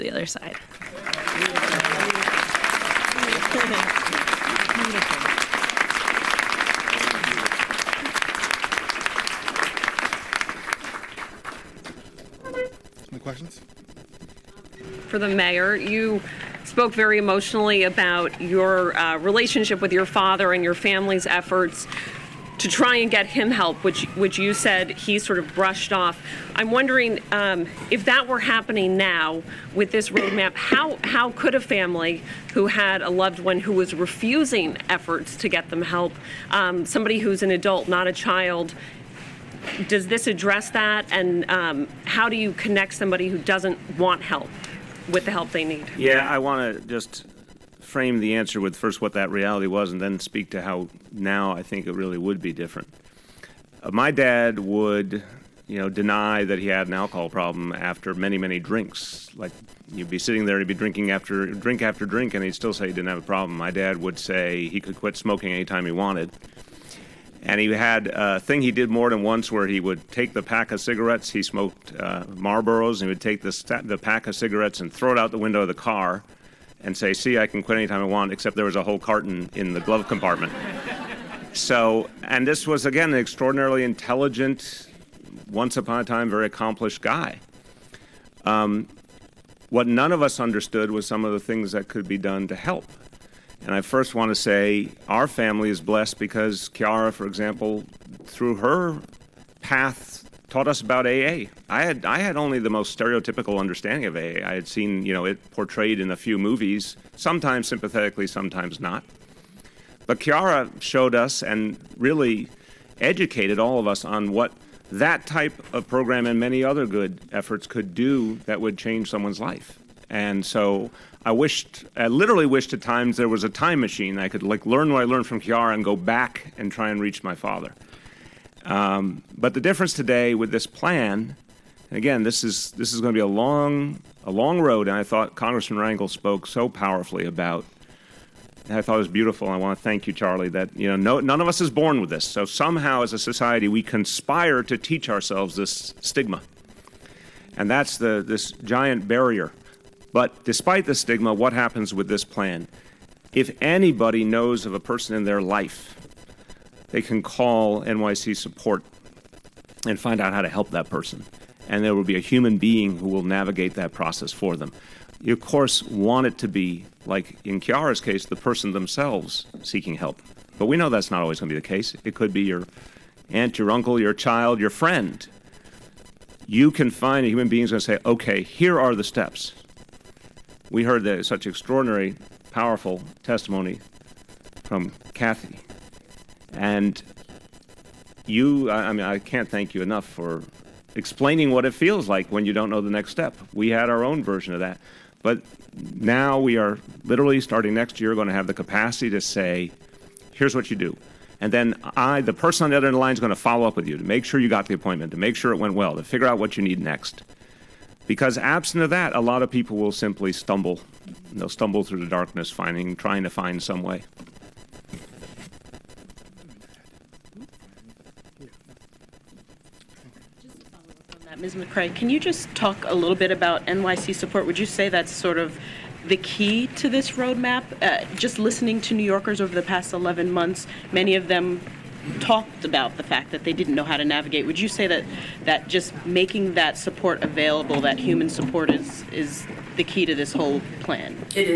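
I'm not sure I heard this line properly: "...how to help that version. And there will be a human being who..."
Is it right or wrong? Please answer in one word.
wrong.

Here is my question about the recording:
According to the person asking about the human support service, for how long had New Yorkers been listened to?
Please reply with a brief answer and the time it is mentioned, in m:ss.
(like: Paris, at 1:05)
11 months, at 3:49.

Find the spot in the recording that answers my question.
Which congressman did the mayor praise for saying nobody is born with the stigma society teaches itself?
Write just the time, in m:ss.
2:15.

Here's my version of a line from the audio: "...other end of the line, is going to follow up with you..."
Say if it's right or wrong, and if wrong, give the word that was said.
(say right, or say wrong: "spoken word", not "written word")
right.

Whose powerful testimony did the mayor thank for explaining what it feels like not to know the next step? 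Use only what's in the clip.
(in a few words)
Kathy.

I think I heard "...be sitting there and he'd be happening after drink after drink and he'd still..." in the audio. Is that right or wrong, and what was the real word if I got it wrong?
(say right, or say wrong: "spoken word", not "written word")
wrong: "drinking", not "happening".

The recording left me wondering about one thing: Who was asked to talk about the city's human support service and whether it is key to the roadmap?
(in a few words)
Ms. McCray.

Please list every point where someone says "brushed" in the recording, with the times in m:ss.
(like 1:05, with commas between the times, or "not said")
0:25.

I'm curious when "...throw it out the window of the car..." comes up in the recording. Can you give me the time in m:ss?
1:14.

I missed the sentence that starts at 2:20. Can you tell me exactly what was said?
That you know, no, none of us is born with this.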